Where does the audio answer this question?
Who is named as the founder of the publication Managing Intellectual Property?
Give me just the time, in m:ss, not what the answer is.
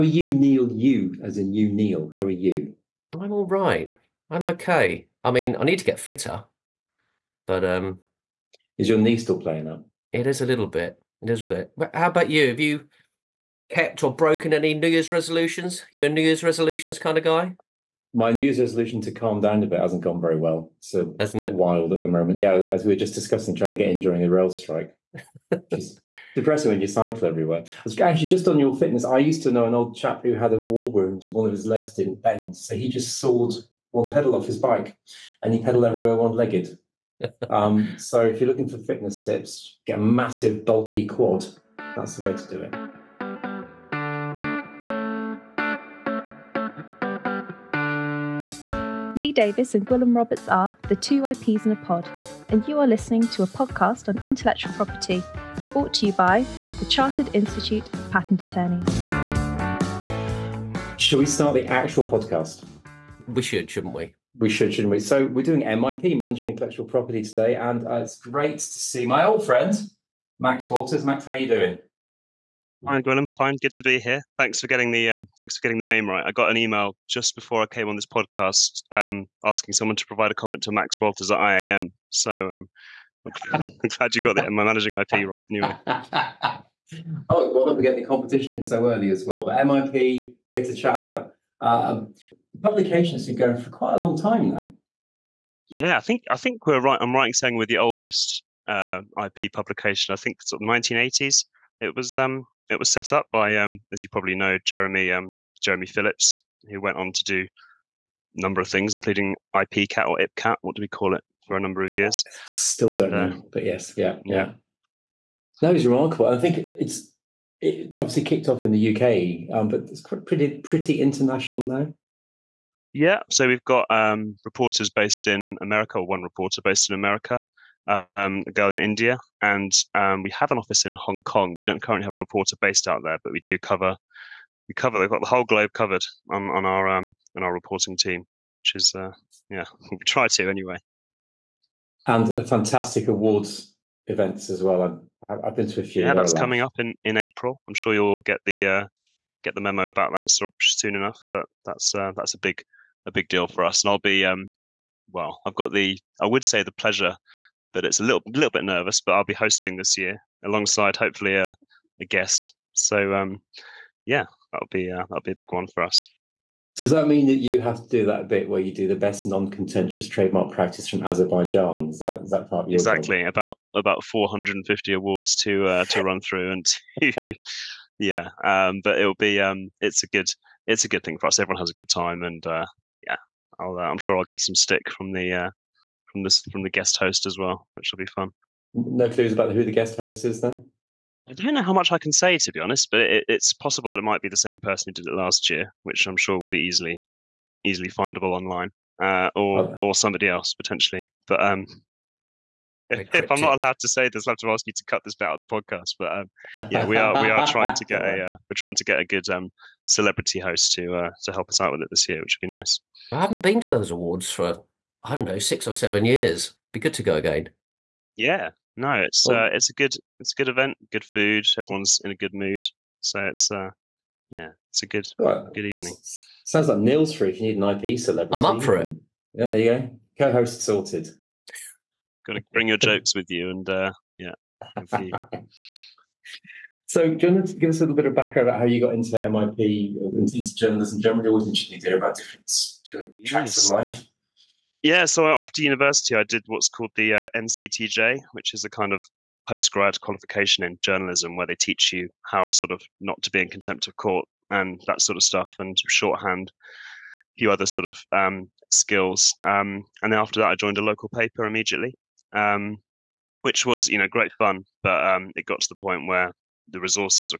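1:45.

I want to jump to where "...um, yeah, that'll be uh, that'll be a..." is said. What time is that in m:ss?
2:43.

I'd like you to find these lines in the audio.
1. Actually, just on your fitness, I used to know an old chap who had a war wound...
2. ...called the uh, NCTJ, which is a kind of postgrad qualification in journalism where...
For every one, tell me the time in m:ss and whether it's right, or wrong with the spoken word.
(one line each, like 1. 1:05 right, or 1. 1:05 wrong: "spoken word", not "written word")
1. 0:28 right
2. 4:06 right.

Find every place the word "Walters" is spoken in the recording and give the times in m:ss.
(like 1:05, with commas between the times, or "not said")
1:10, 1:21.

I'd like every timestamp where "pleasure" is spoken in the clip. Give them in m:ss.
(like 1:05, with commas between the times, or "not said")
2:36.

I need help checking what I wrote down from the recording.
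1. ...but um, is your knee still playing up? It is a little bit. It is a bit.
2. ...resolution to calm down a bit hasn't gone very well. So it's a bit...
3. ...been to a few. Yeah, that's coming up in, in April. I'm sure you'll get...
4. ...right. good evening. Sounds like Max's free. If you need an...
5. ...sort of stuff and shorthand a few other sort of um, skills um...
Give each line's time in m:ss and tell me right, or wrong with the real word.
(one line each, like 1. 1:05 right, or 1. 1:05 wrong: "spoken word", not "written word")
1. 0:07 right
2. 0:18 right
3. 2:25 right
4. 3:45 wrong: "Neil", not "Max"
5. 4:15 right.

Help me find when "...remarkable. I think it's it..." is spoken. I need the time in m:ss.
1:55.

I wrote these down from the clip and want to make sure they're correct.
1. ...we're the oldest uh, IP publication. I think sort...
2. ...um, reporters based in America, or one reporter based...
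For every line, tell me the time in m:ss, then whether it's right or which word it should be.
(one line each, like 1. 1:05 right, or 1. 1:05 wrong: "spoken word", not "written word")
1. 1:37 right
2. 2:03 right.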